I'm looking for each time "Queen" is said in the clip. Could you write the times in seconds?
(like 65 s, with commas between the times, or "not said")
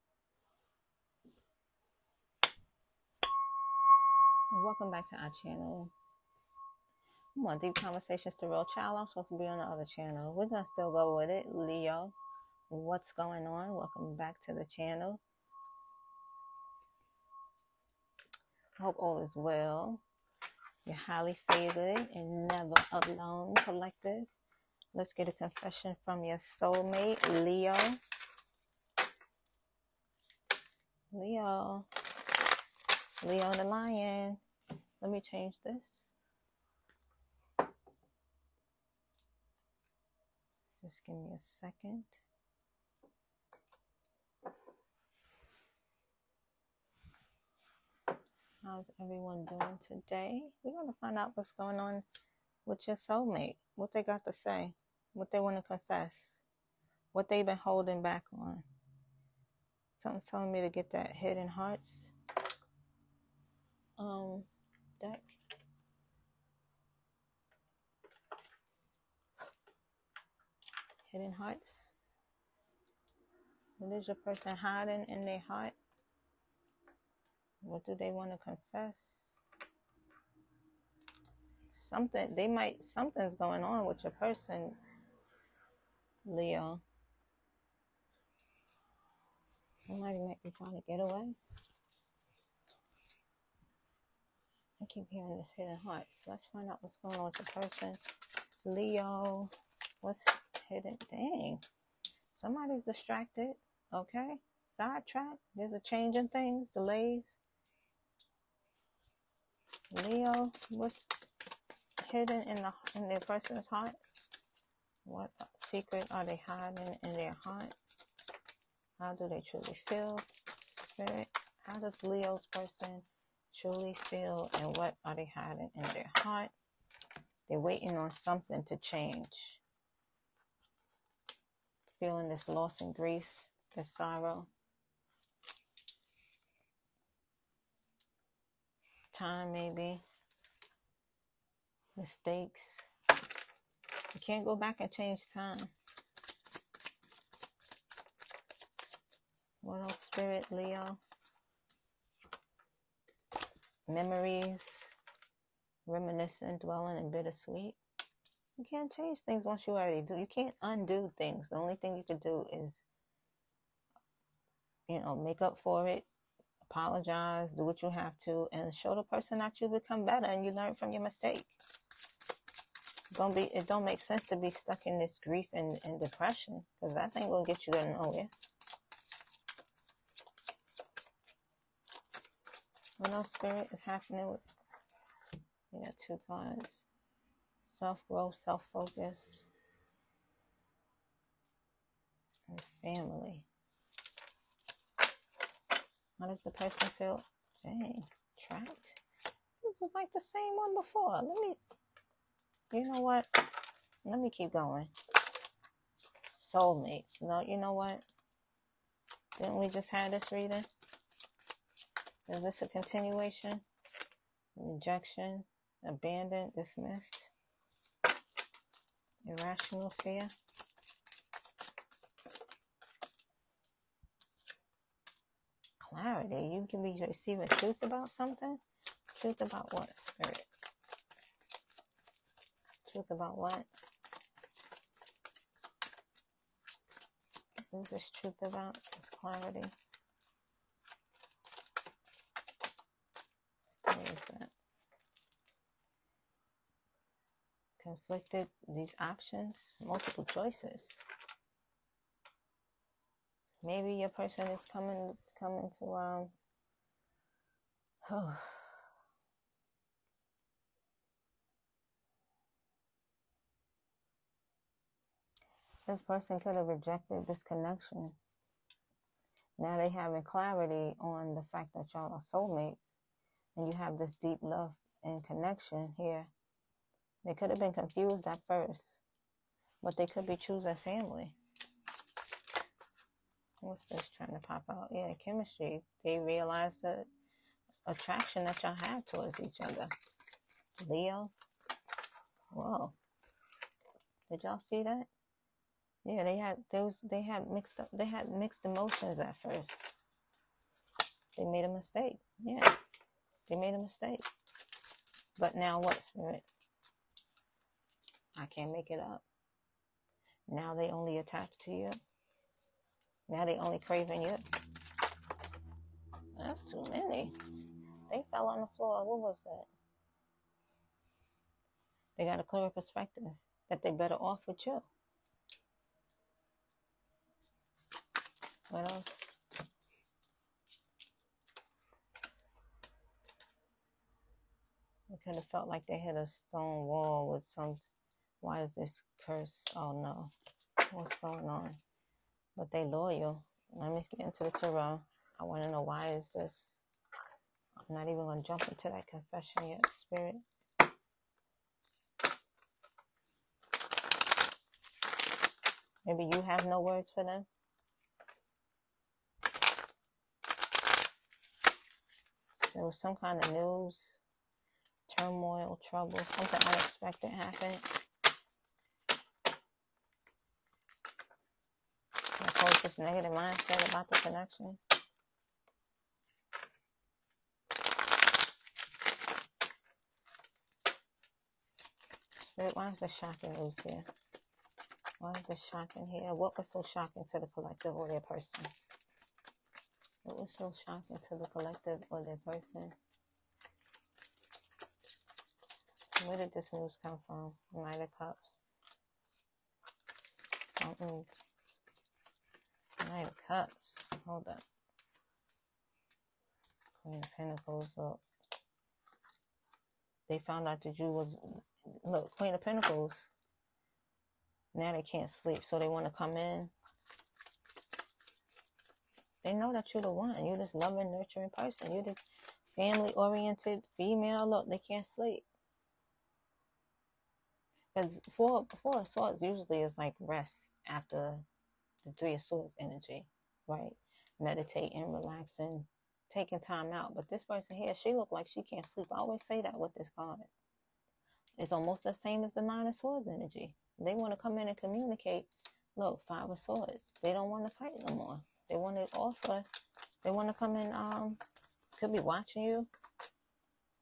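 407 s, 412 s.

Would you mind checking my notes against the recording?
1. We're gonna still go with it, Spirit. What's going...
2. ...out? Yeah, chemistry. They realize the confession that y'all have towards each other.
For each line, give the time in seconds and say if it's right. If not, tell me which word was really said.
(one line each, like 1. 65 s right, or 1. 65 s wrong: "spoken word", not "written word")
1. 10 s wrong: "Leo", not "Spirit"
2. 284 s wrong: "attraction", not "confession".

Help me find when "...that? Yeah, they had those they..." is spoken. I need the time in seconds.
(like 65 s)
294 s.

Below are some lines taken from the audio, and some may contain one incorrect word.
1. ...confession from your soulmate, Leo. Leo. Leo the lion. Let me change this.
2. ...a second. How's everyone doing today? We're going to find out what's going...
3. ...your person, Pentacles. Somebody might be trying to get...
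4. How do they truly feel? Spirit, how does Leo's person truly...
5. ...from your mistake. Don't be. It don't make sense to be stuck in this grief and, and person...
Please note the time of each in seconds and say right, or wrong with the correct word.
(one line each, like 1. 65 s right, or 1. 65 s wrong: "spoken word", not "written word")
1. 25 s right
2. 41 s right
3. 84 s wrong: "Leo", not "Pentacles"
4. 118 s right
5. 170 s wrong: "depression", not "person".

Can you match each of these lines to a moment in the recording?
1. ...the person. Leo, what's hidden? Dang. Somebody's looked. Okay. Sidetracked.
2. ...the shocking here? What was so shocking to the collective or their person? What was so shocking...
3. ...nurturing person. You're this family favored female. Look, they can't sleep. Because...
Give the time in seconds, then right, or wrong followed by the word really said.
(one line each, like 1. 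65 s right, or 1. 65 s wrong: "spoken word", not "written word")
1. 97 s wrong: "distracted", not "looked"
2. 385 s right
3. 421 s wrong: "oriented", not "favored".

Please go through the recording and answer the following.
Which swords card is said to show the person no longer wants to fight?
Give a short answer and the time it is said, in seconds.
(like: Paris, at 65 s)
Five of Swords, at 446 s.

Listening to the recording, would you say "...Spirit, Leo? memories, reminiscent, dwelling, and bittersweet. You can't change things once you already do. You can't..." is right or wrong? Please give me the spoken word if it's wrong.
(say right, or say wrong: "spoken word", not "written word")
right.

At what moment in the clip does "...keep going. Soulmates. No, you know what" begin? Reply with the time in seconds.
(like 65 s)
204 s.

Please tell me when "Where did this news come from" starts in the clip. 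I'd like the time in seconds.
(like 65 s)
396 s.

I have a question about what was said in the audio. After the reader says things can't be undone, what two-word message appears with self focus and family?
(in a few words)
Self growth.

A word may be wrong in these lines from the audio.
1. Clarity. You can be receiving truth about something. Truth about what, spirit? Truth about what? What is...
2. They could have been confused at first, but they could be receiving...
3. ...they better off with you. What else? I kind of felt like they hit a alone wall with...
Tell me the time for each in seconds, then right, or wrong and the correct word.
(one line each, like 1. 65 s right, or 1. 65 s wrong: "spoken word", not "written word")
1. 225 s right
2. 277 s wrong: "choosing", not "receiving"
3. 323 s wrong: "stone", not "alone".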